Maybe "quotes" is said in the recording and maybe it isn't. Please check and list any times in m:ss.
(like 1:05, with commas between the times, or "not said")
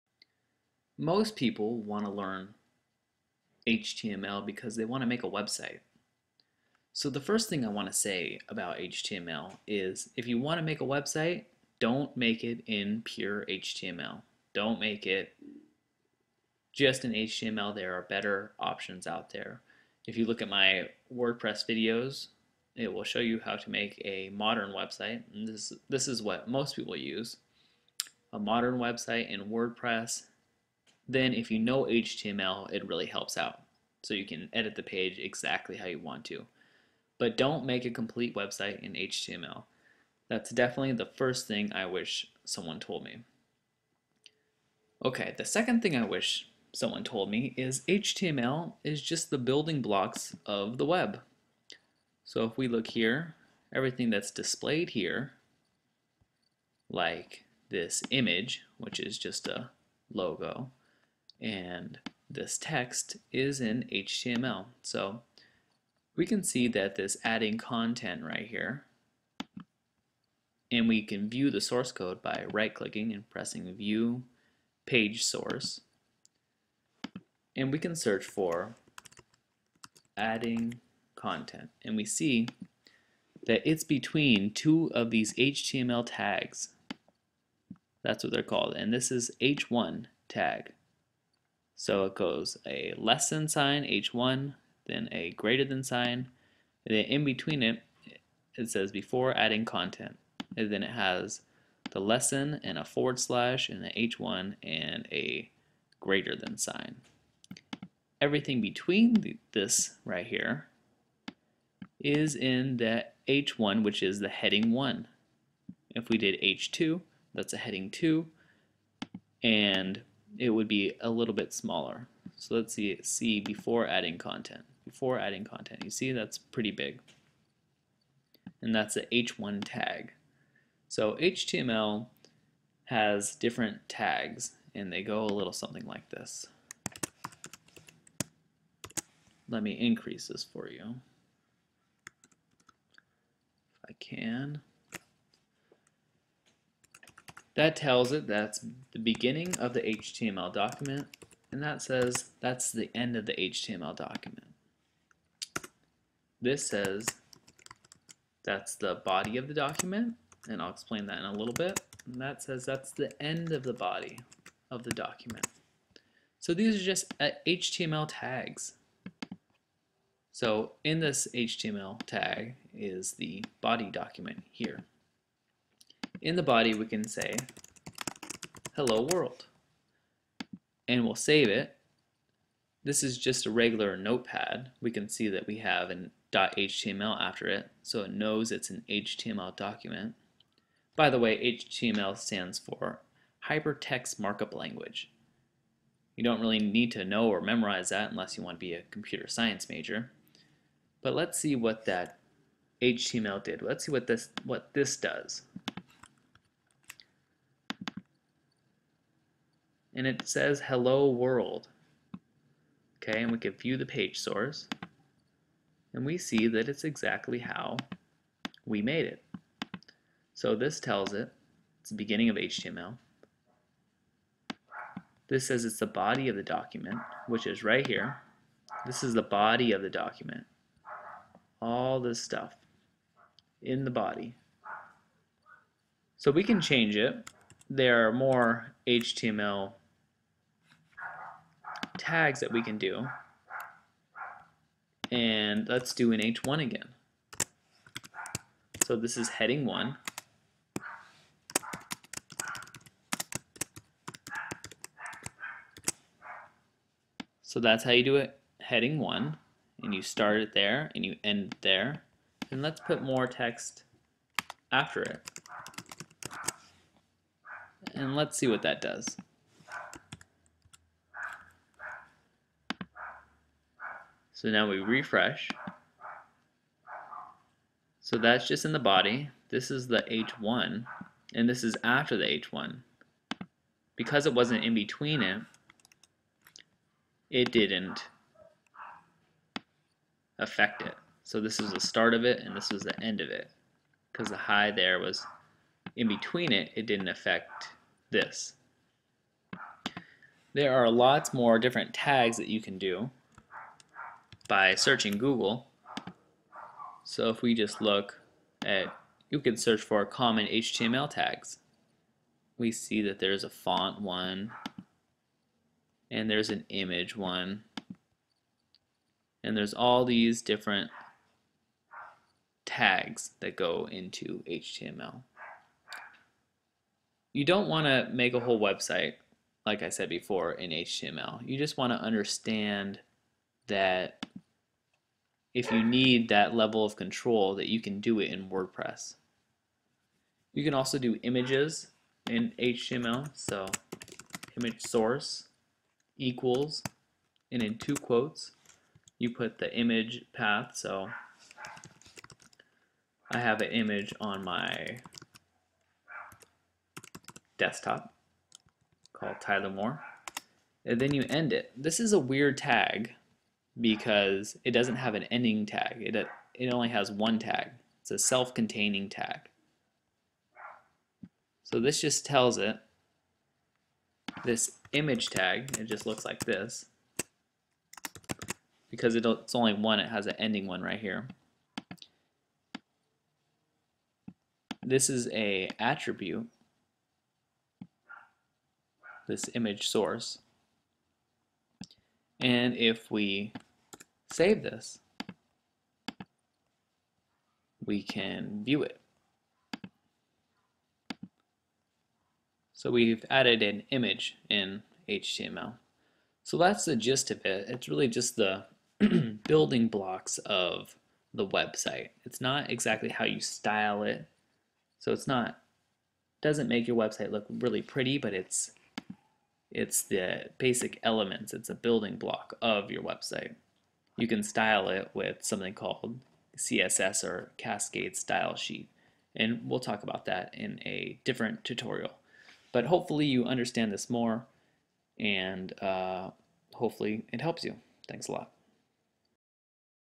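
5:47.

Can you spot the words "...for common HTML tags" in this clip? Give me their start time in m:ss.
5:09.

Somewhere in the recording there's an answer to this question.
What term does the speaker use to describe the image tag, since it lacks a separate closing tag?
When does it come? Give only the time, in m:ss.
6:08.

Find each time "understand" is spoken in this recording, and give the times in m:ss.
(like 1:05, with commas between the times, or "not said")
5:31, 7:13.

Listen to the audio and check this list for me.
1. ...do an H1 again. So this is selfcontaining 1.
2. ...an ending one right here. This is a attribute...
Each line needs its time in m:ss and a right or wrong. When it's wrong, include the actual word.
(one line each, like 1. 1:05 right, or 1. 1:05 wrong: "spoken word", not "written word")
1. 4:05 wrong: "heading", not "selfcontaining"
2. 6:20 right.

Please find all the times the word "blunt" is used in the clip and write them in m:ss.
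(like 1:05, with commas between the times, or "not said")
not said.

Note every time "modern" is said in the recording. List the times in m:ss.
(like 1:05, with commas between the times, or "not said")
0:24, 0:28.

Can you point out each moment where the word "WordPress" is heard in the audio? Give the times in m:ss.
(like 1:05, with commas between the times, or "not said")
0:21, 0:29, 5:38.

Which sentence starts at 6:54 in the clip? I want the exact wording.
So it's not, doesn't make your website look really pretty, but it's it's the basic elements.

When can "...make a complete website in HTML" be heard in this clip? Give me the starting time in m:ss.
0:37.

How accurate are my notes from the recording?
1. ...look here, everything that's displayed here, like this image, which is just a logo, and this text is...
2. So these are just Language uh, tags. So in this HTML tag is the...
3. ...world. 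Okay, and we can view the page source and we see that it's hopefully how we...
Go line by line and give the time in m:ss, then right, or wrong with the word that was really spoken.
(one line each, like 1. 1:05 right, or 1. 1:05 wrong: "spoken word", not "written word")
1. 0:52 right
2. 2:46 wrong: "HTML", not "Language"
3. 3:31 wrong: "exactly", not "hopefully".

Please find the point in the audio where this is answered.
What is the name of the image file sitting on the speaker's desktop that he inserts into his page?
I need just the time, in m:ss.
5:59.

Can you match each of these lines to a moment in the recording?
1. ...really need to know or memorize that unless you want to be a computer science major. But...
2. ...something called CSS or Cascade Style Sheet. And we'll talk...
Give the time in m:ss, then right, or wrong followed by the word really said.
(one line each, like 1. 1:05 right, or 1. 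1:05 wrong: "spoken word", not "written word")
1. 3:16 right
2. 7:05 right.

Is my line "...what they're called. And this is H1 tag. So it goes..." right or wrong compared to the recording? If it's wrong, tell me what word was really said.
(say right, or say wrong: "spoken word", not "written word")
right.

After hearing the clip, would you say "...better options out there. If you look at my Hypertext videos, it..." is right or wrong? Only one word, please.
wrong.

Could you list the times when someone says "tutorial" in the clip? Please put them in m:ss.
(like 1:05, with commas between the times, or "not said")
7:11.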